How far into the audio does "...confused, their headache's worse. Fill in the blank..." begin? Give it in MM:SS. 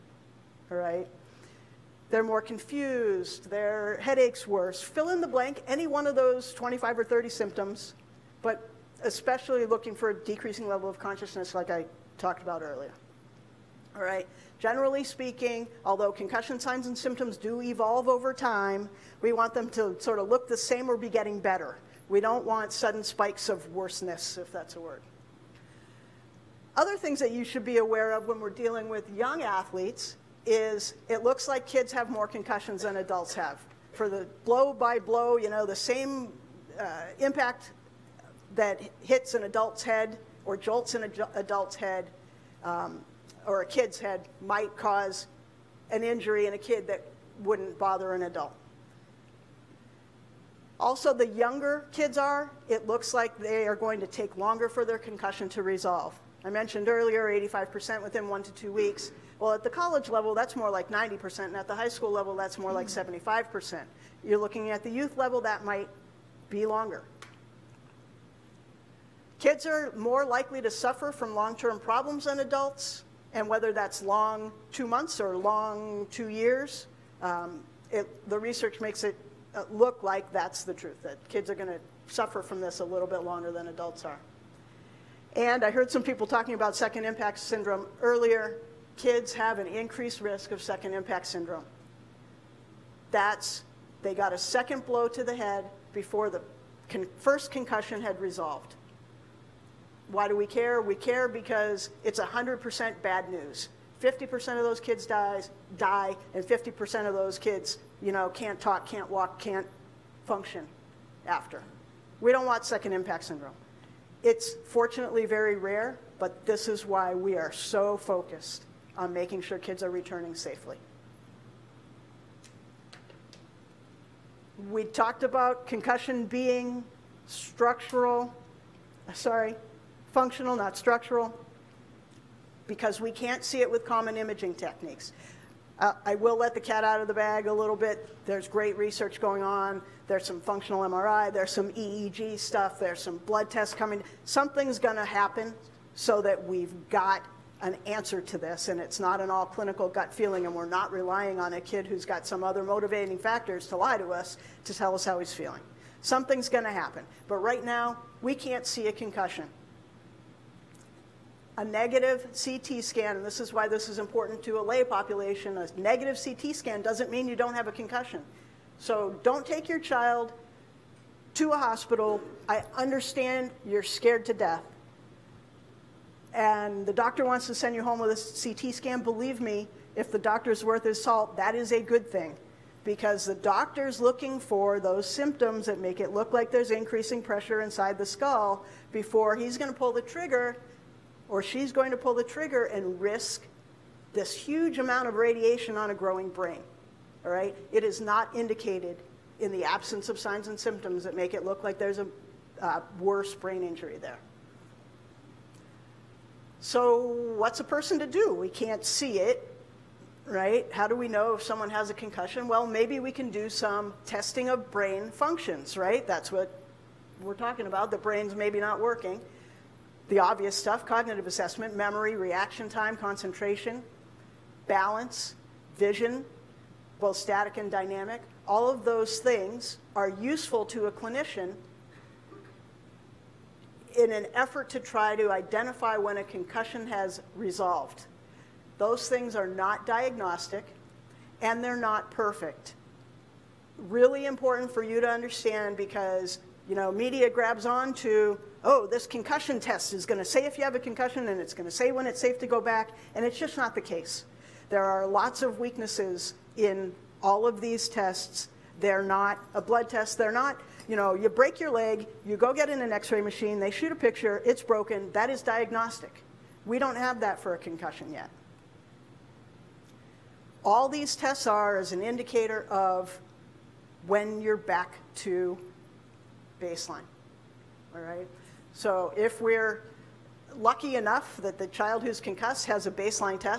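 00:02.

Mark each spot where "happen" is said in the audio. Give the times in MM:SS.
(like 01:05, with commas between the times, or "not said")
02:25, 02:36.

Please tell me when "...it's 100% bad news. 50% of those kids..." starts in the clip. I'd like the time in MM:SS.
01:42.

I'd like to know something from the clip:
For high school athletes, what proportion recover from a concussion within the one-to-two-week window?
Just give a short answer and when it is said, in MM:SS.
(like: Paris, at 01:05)
75%, at 01:02.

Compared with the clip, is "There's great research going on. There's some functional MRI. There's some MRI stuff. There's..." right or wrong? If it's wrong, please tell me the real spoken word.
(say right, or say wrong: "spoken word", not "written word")
wrong: "EEG", not "MRI".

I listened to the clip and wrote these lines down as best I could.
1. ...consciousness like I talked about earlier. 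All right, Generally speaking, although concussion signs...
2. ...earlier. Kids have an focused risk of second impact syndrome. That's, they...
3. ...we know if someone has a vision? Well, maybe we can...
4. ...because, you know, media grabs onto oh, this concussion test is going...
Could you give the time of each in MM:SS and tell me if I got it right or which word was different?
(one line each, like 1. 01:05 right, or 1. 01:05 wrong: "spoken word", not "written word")
1. 00:10 right
2. 01:28 wrong: "increased", not "focused"
3. 03:30 wrong: "concussion", not "vision"
4. 04:05 right.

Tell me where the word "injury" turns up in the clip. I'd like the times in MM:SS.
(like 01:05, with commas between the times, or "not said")
00:46, 03:23.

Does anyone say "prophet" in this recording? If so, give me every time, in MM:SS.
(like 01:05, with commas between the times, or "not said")
not said.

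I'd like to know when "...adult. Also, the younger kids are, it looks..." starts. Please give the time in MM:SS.
00:48.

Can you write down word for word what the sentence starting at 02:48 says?
So don't take your child to a hospital.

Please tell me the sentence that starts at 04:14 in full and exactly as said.
There are lots of weaknesses in all of these tests.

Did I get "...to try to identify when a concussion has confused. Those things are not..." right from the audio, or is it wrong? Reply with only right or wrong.
wrong.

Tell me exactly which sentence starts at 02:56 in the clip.
And the doctor wants to send you home with a CT scan.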